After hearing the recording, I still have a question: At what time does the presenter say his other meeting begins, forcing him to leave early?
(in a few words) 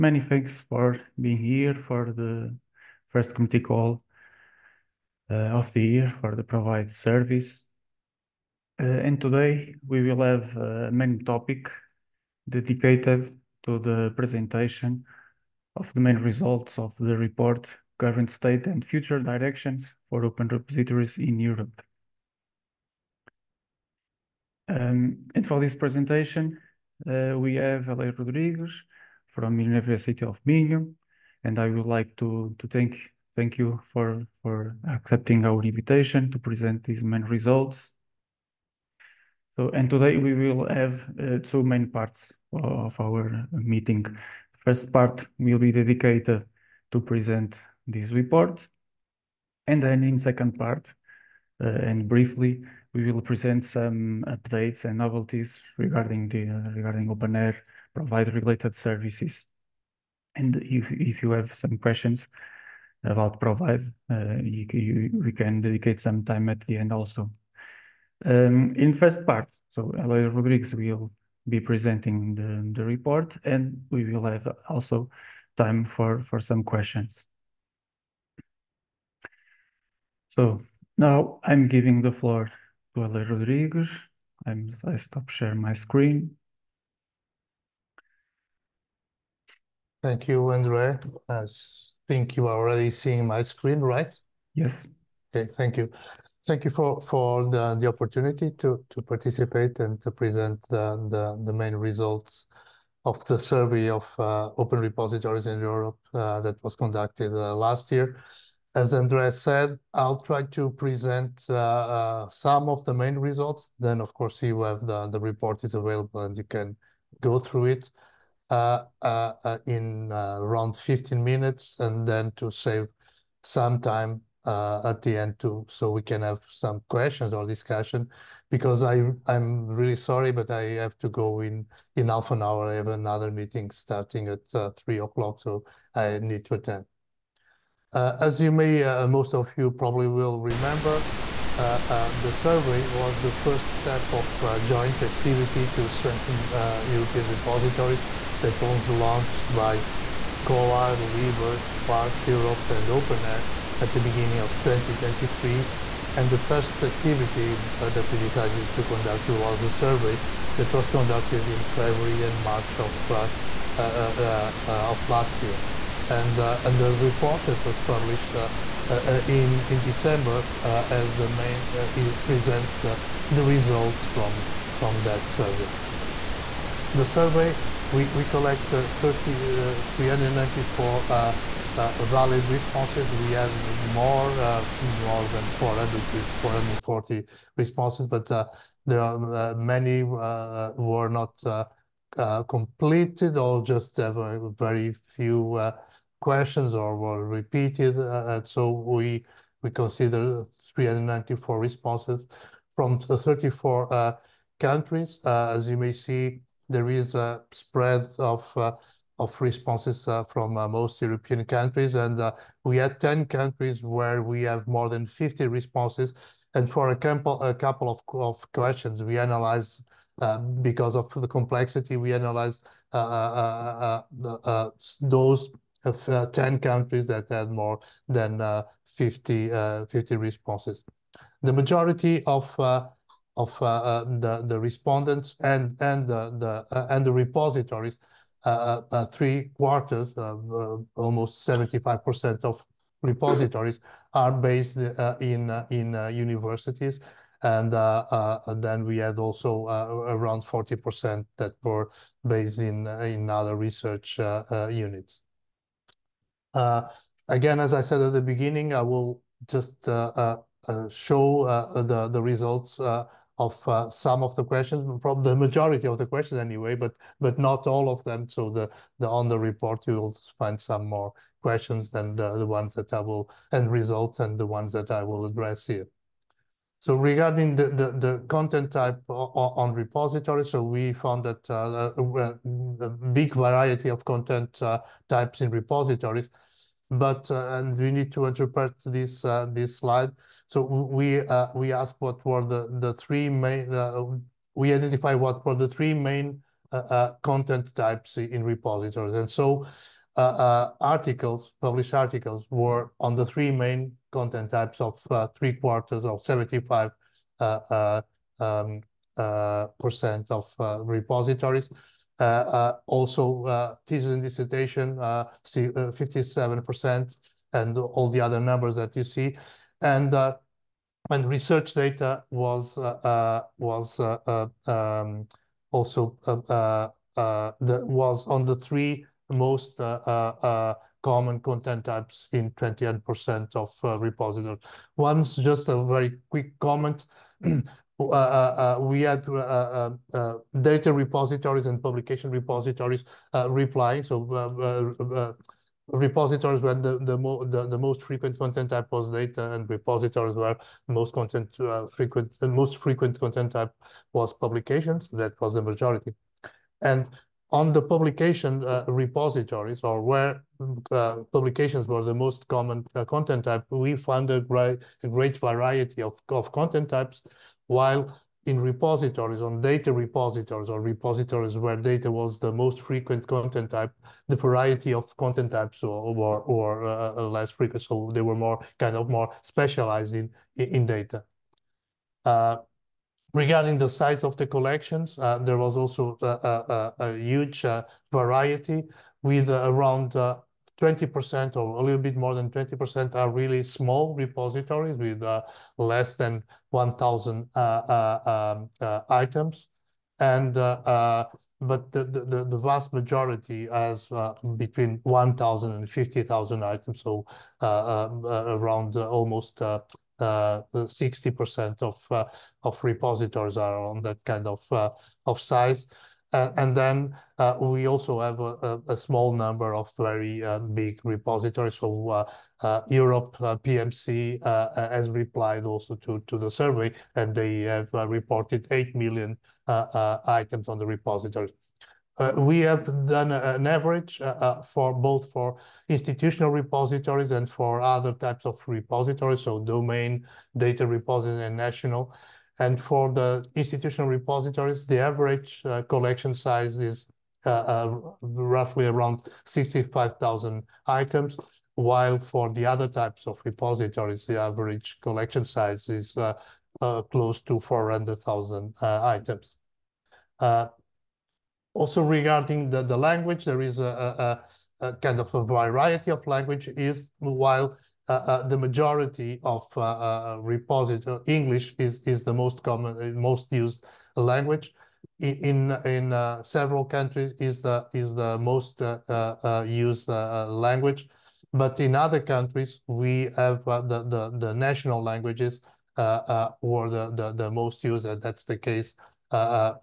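3 o'clock.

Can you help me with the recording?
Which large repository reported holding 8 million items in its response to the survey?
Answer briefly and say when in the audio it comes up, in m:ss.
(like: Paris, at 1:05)
Europe PMC, at 7:02.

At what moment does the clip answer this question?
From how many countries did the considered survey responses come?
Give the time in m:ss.
3:22.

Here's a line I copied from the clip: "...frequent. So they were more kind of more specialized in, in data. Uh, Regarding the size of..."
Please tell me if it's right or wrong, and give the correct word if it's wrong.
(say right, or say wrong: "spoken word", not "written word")
right.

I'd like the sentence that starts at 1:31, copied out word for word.
I think you are already seeing my screen, right?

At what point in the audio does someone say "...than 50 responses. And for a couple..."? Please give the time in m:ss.
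3:34.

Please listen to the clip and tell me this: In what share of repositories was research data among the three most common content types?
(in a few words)
21%.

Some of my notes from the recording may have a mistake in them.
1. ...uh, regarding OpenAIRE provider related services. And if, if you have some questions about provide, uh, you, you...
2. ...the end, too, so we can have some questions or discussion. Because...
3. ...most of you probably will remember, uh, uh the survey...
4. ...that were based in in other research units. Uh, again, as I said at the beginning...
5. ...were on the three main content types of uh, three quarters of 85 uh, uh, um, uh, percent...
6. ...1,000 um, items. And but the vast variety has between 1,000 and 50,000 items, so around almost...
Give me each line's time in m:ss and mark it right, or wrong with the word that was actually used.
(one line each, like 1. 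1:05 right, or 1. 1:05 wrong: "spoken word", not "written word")
1. 0:56 right
2. 2:05 right
3. 2:19 right
4. 4:11 right
5. 5:02 wrong: "75", not "85"
6. 6:36 wrong: "majority", not "variety".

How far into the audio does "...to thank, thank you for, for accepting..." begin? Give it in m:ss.
0:32.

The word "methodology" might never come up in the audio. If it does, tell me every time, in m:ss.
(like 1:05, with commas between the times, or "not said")
not said.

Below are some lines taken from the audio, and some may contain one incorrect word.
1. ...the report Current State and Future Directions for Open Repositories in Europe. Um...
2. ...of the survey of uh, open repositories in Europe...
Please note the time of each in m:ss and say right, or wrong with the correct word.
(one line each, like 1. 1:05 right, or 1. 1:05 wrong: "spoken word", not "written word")
1. 0:16 right
2. 1:43 right.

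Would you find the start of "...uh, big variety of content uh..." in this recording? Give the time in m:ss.
4:42.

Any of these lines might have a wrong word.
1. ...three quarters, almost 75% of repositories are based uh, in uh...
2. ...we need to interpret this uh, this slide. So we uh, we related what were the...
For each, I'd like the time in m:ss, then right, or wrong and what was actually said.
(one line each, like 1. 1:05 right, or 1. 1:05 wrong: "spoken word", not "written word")
1. 3:59 right
2. 4:47 wrong: "asked", not "related".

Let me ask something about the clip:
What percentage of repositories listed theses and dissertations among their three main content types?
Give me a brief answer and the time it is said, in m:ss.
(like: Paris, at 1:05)
57%, at 5:15.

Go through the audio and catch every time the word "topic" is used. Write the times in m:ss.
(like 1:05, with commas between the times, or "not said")
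0:11.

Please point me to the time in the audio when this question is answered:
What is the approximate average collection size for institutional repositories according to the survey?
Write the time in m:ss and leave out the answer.
7:29.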